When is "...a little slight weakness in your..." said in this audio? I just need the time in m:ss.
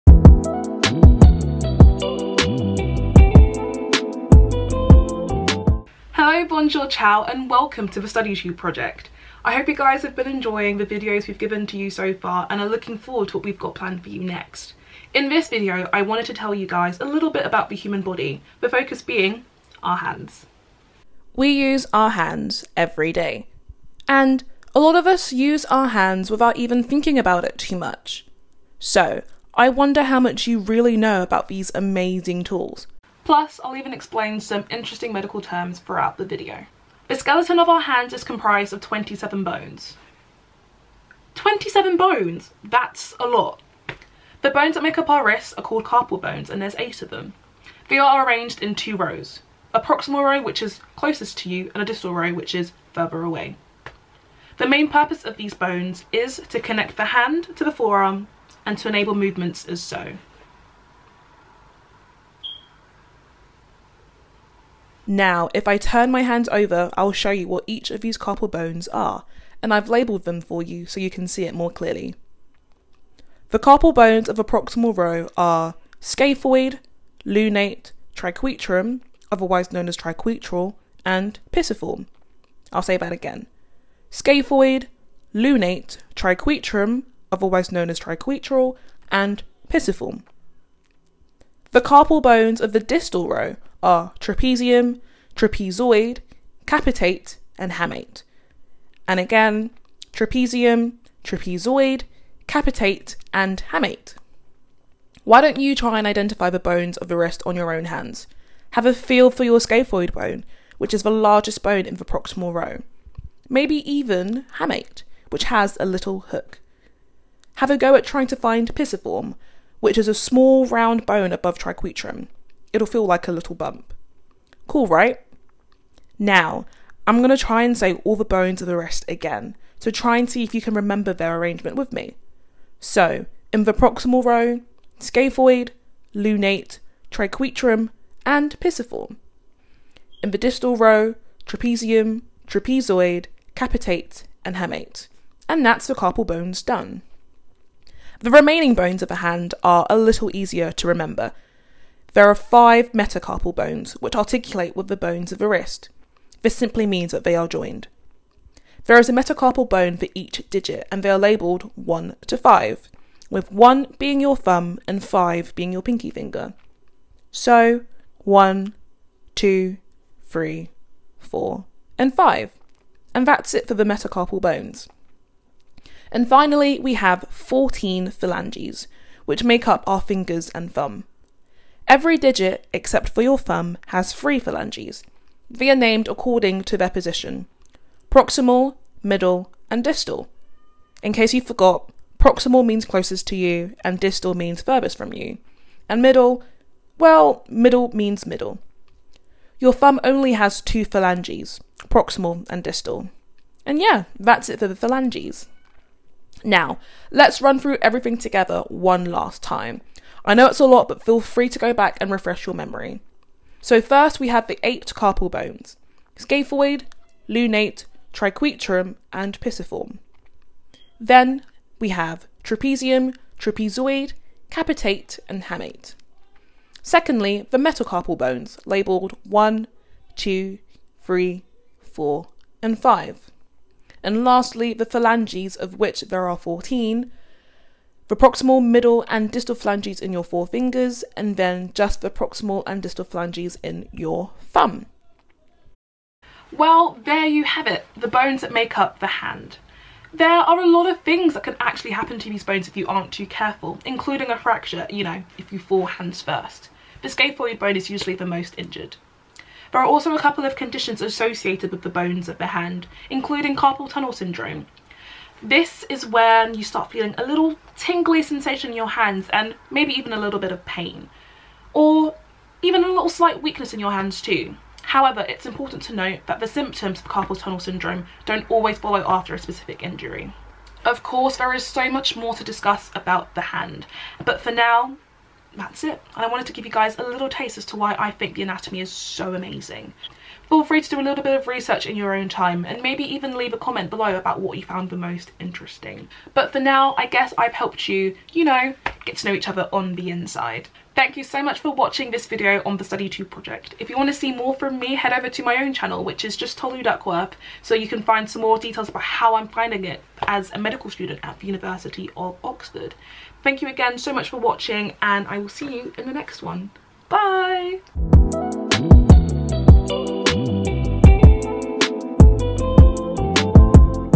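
4:32.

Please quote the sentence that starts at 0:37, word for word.
The skeleton of our hands is comprised of 27 bones.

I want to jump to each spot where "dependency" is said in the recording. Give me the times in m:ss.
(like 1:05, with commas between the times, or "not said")
not said.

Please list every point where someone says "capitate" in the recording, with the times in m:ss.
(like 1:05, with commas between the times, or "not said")
1:36, 1:42, 2:23, 3:44.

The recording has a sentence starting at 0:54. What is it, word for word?
The main purpose of these bones is to connect the hand to the forearm and to enable movements as so.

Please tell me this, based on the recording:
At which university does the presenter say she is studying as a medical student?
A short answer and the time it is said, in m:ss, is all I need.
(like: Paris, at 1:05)
University of Oxford, at 5:11.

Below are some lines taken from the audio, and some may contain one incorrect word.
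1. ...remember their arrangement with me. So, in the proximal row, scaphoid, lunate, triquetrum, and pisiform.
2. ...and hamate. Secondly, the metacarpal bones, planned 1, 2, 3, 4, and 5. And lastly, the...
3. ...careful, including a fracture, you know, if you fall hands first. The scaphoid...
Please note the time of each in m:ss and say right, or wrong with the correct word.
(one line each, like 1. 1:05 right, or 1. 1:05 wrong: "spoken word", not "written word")
1. 2:10 right
2. 3:45 wrong: "labelled", not "planned"
3. 4:13 right.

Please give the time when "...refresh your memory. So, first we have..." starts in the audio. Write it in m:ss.
3:32.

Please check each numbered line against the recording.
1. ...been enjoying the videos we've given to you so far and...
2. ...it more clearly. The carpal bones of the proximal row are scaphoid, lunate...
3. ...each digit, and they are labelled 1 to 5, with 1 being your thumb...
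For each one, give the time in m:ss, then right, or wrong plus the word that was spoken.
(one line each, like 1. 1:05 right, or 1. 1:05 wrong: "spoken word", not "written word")
1. 0:10 right
2. 1:11 right
3. 2:40 right.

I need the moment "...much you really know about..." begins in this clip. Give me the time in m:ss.
0:30.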